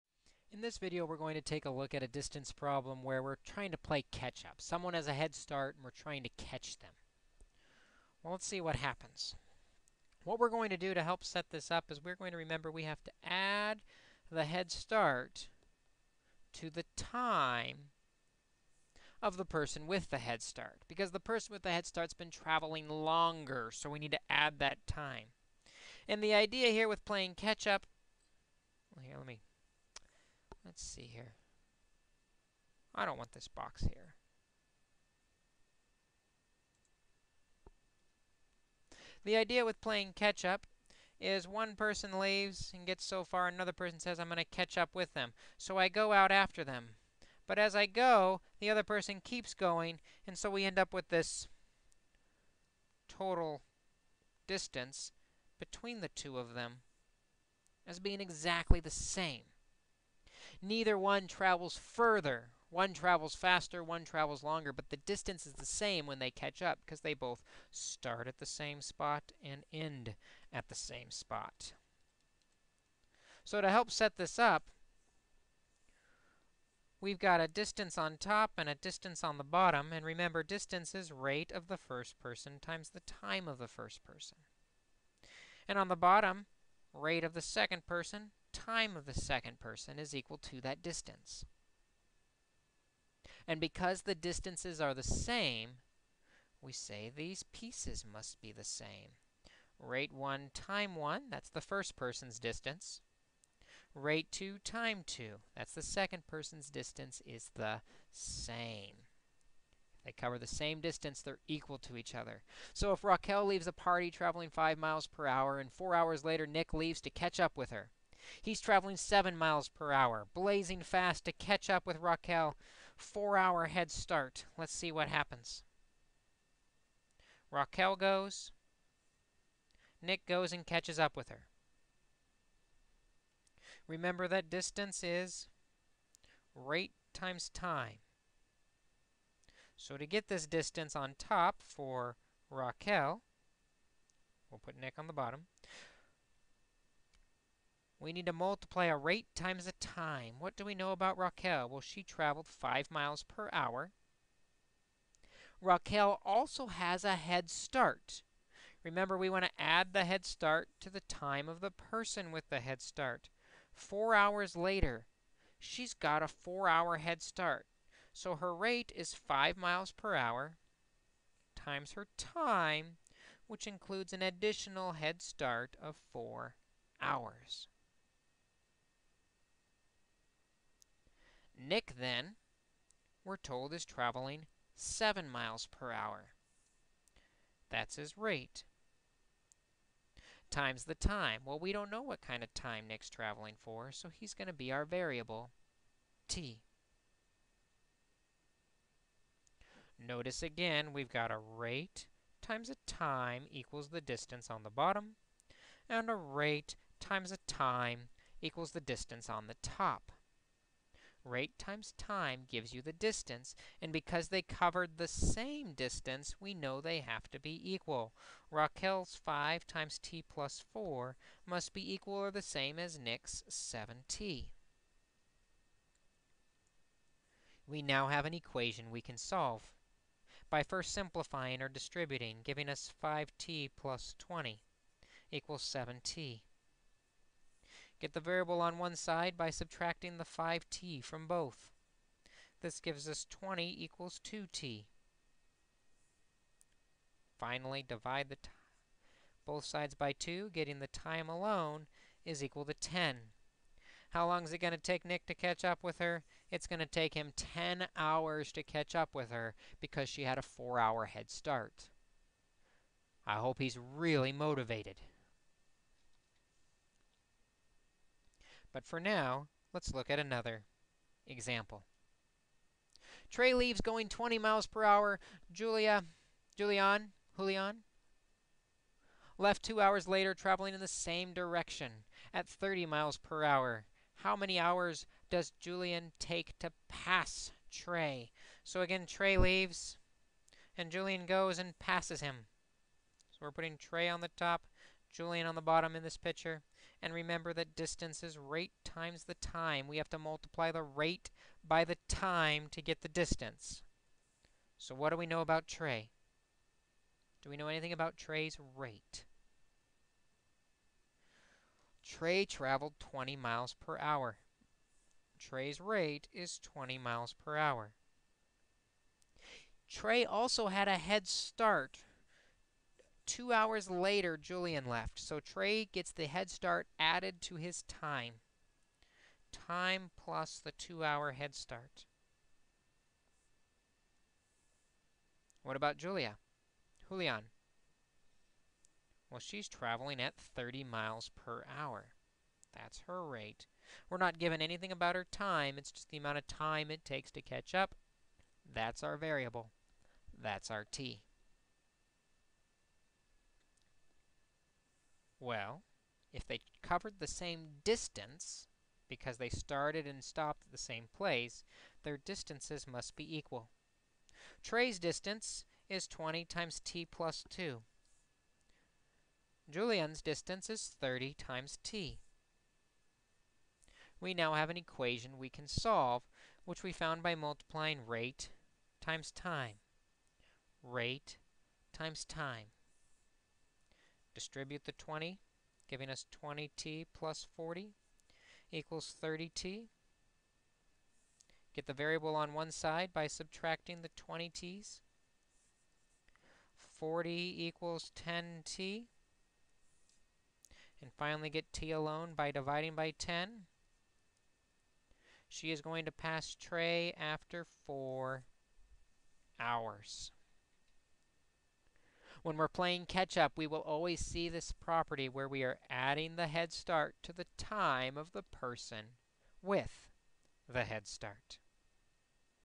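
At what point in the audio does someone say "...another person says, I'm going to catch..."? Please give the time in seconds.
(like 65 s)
43 s.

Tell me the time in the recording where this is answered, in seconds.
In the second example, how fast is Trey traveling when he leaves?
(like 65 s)
273 s.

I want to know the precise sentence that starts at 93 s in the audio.
And because the distances are the same, we say these pieces must be the same.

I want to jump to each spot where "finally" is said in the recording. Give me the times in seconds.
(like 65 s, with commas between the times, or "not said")
247 s, 401 s.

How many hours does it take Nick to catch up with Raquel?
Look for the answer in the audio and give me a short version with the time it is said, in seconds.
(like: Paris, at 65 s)
10 hours, at 257 s.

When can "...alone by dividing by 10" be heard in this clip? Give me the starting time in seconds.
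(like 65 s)
401 s.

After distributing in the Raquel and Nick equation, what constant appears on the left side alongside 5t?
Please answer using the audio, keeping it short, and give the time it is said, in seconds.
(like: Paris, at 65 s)
20, at 233 s.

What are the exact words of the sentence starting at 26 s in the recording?
And the idea here with playing catch-up, well, here, let me Let's see here.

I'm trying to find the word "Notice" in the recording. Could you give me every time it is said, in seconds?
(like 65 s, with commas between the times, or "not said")
200 s.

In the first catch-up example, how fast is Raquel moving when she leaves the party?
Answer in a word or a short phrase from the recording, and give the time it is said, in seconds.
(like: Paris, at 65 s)
5 miles per hour, at 114 s.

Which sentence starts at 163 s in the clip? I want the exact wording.
Four hours later, she's got a four-hour head start.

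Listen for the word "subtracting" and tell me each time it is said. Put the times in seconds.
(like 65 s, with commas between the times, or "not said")
239 s, 393 s.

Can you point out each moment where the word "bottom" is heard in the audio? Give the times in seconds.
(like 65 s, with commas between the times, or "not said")
79 s, 85 s, 145 s, 204 s, 295 s.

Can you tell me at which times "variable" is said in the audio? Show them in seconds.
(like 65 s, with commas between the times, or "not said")
194 s, 238 s, 349 s, 391 s.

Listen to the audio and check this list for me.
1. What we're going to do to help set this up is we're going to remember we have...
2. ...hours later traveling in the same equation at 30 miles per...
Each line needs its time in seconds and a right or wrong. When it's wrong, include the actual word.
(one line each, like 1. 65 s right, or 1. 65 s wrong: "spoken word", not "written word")
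1. 10 s right
2. 279 s wrong: "direction", not "equation".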